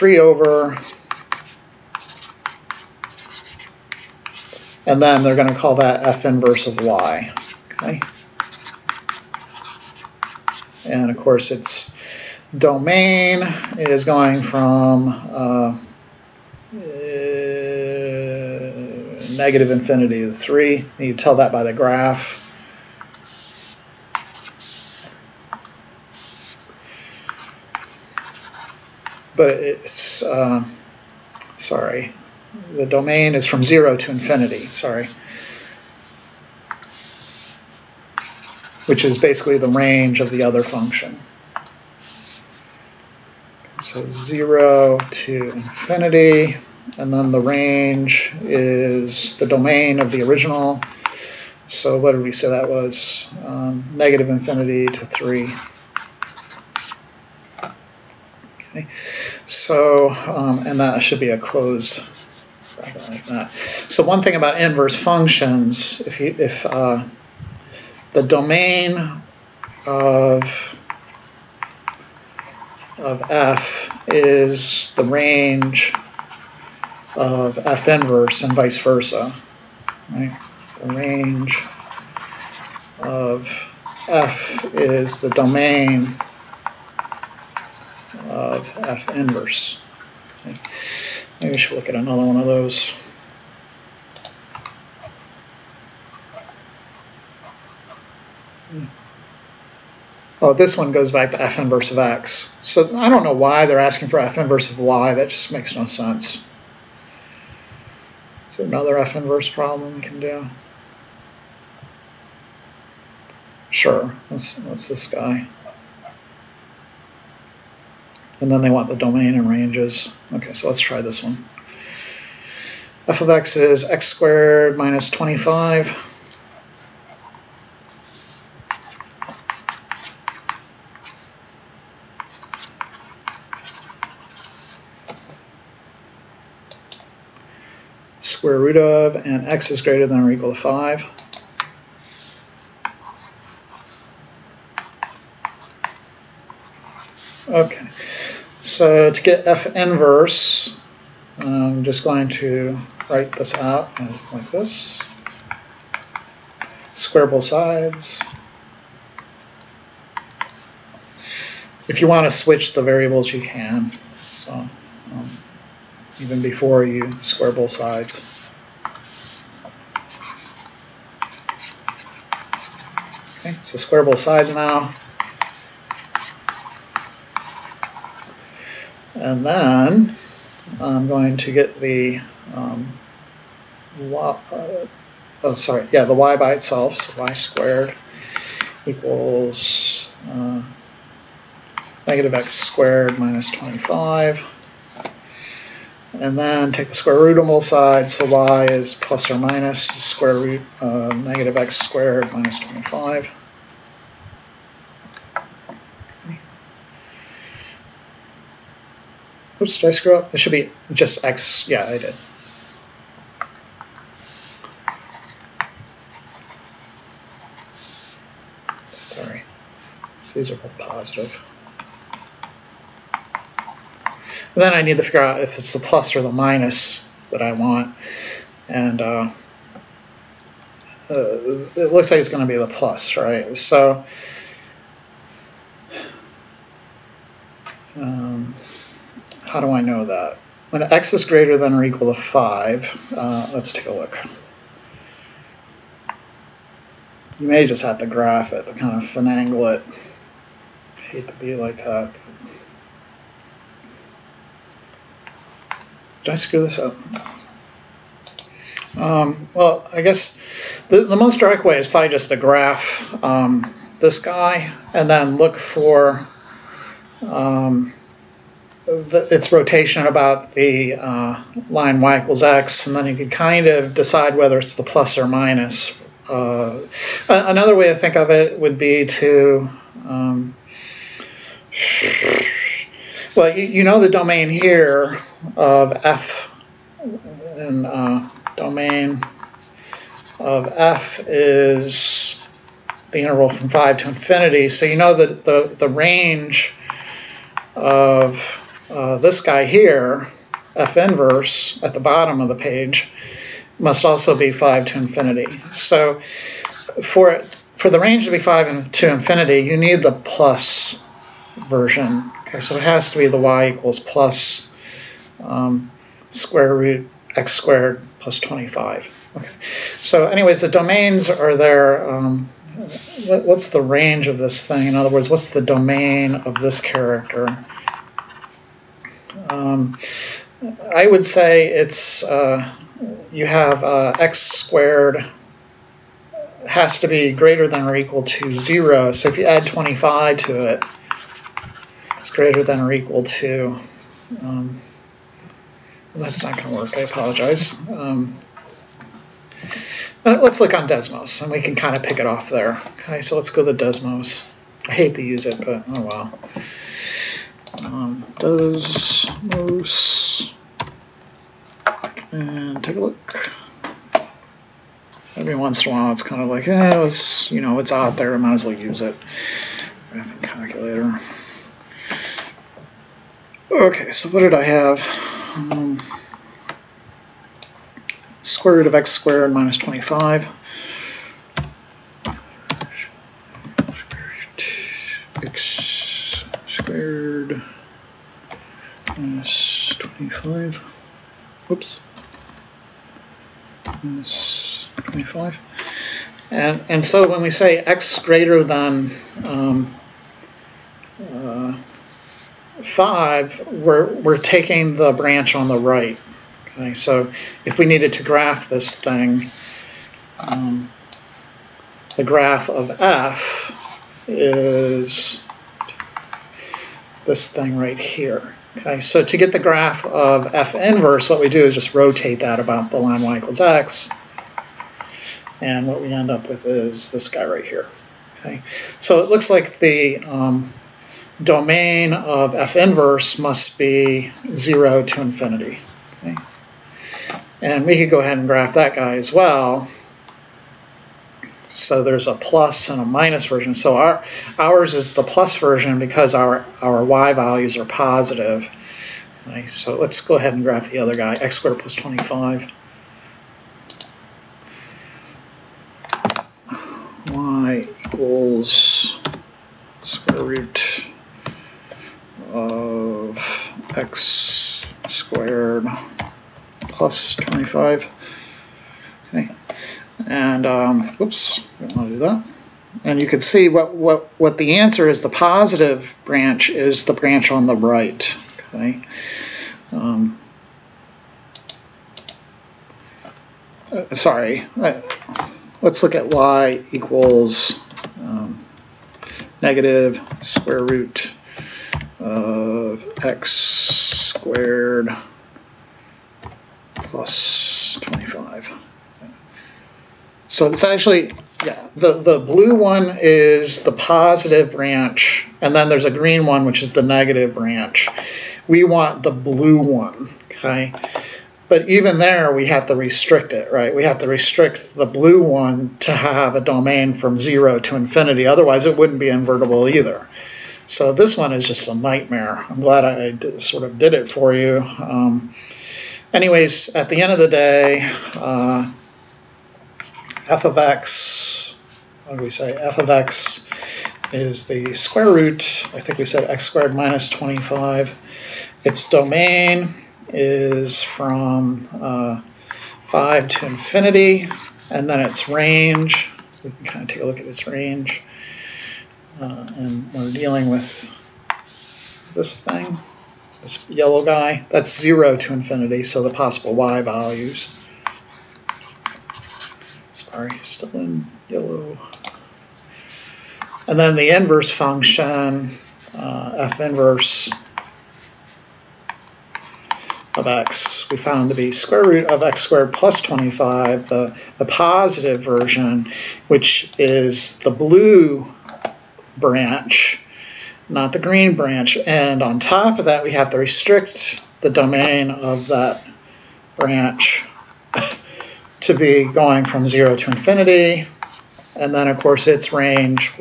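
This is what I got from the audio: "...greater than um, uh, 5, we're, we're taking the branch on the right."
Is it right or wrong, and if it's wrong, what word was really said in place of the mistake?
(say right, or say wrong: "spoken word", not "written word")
right.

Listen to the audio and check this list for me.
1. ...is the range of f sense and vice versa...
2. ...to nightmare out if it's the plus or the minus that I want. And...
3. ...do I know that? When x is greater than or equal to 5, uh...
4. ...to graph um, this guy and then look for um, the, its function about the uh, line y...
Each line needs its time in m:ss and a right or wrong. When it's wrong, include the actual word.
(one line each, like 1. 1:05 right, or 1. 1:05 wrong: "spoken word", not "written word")
1. 1:14 wrong: "inverse", not "sense"
2. 3:44 wrong: "figure", not "nightmare"
3. 3:59 right
4. 4:22 wrong: "rotation", not "function".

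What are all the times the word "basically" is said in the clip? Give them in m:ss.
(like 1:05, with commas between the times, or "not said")
0:39.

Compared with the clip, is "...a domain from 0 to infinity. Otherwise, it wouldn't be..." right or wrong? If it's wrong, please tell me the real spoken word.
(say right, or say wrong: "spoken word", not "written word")
right.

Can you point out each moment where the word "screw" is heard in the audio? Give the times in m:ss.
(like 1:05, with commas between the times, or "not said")
3:29, 4:16.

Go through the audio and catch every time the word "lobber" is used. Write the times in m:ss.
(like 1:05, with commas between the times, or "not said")
not said.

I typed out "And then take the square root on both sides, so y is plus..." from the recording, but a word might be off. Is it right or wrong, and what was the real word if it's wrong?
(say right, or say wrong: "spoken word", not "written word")
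right.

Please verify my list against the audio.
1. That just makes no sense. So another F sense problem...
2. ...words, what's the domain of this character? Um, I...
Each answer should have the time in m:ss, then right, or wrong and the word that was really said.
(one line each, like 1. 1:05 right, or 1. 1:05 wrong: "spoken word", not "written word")
1. 1:45 wrong: "inverse", not "sense"
2. 5:25 right.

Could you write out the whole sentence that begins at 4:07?
You may just have to graph it, to kind of finagle it.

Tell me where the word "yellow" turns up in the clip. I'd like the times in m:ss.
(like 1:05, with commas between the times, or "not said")
9:13, 9:21.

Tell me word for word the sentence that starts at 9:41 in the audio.
And on top of that, we have to restrict the domain of that branch to be going from 0 to infinity.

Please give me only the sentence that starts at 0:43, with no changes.
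So zero to infinity, and then the range is the domain of the original.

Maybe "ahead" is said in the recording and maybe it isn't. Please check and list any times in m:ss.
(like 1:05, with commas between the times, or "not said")
7:18, 7:30.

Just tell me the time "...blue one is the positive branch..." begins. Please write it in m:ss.
8:22.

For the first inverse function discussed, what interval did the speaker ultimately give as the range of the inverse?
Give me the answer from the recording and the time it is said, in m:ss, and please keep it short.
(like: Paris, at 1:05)
negative infinity to 3, at 0:53.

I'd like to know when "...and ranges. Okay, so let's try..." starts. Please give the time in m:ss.
1:59.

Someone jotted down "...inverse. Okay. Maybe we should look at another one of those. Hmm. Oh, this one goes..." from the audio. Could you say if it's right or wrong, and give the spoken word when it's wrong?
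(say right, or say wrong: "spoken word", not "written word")
right.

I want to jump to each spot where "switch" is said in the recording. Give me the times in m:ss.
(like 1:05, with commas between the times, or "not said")
2:42.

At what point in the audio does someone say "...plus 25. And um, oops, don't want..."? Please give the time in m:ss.
7:46.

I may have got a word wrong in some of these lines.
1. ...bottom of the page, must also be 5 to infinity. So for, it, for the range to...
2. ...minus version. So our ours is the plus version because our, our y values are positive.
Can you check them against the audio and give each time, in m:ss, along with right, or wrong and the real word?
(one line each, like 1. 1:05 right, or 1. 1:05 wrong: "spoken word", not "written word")
1. 5:01 right
2. 7:23 right.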